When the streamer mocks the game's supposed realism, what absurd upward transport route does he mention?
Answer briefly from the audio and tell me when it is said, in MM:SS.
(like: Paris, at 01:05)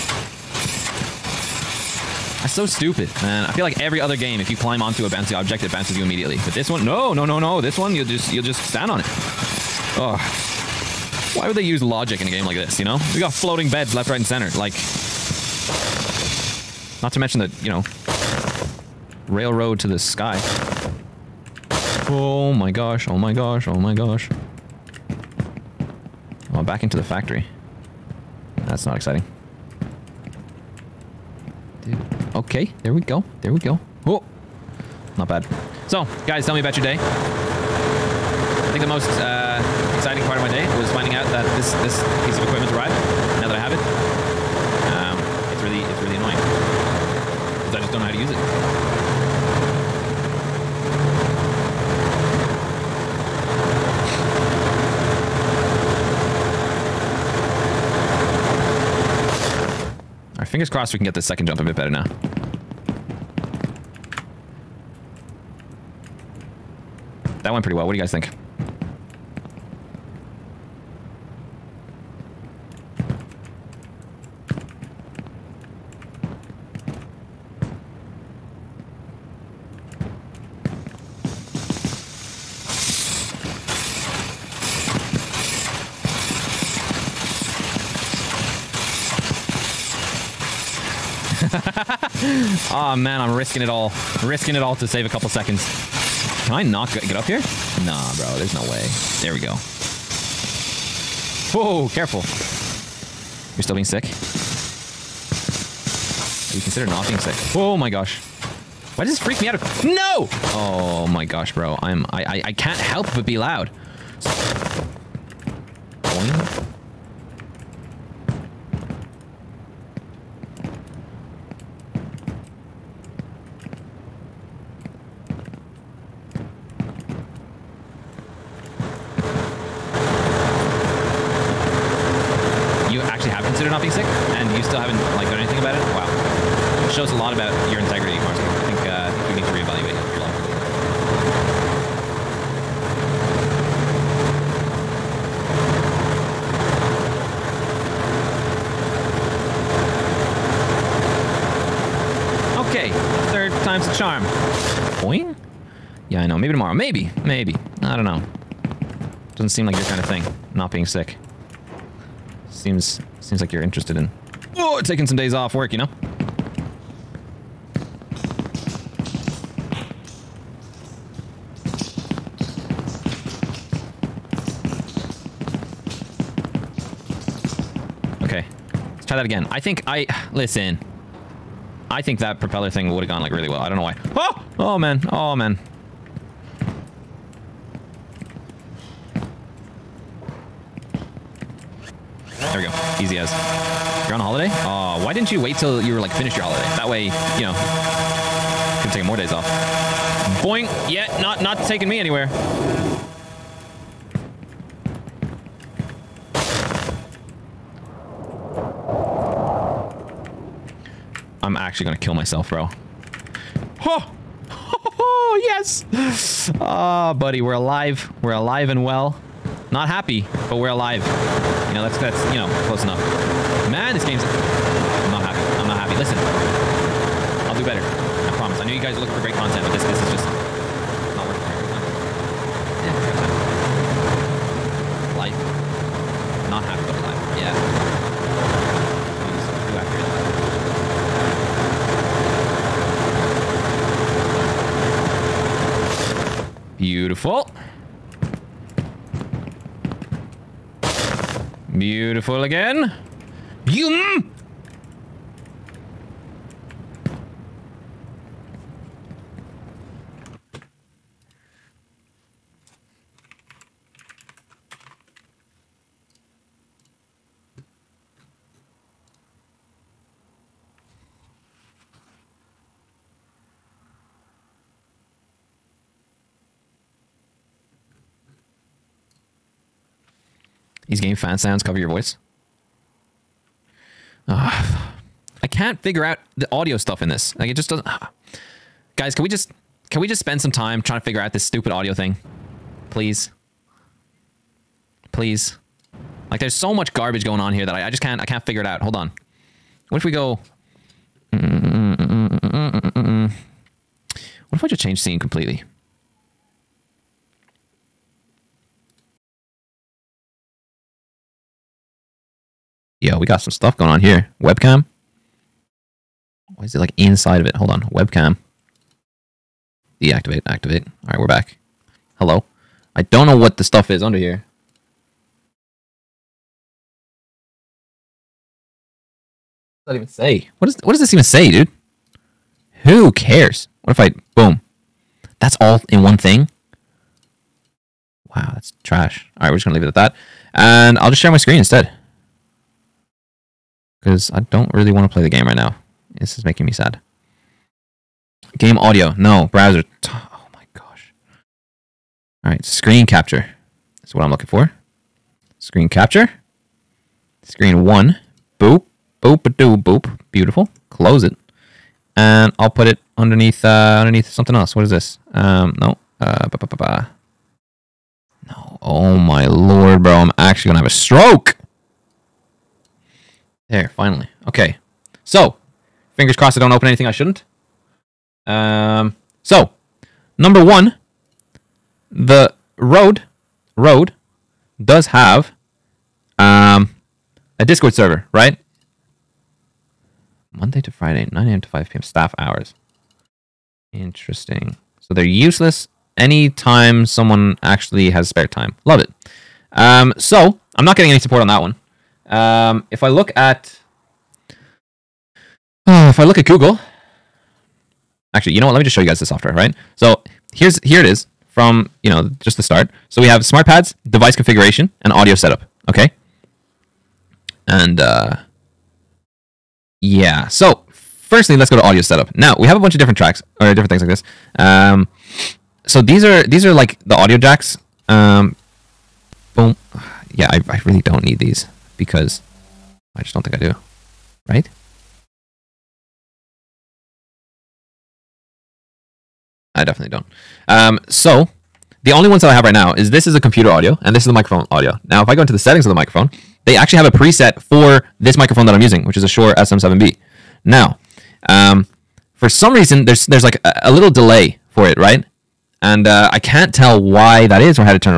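railroad to the sky, at 00:19.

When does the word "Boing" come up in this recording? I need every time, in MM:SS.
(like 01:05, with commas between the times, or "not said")
01:56, 03:20.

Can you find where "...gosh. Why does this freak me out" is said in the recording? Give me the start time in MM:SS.
01:47.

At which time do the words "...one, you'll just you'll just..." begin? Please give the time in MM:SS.
00:07.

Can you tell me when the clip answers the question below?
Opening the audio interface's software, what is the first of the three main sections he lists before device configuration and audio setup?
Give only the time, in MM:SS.
06:53.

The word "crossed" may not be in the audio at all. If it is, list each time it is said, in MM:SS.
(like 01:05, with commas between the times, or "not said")
01:00, 06:16.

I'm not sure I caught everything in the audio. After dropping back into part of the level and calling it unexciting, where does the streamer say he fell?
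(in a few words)
the factory.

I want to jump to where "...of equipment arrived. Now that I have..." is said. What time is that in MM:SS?
00:42.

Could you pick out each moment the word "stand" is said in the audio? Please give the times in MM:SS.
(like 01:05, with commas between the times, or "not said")
00:08.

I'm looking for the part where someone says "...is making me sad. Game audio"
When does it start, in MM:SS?
05:46.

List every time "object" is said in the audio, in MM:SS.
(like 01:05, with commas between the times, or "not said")
00:05.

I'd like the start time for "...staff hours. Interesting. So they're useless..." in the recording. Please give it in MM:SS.
06:32.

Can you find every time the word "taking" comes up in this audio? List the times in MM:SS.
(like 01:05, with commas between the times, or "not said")
02:44, 03:21.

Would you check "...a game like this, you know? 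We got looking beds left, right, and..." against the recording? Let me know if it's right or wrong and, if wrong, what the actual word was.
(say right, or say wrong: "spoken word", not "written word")
wrong: "floating", not "looking".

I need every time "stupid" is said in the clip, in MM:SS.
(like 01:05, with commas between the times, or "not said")
00:02, 04:51.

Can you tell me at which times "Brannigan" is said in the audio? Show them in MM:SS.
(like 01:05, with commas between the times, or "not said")
not said.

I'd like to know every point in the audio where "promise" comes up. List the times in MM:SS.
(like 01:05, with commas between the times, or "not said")
03:48.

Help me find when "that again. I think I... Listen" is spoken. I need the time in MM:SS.
02:59.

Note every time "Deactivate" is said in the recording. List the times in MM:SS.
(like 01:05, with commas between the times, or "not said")
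05:19.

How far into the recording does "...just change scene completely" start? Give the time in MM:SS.
05:04.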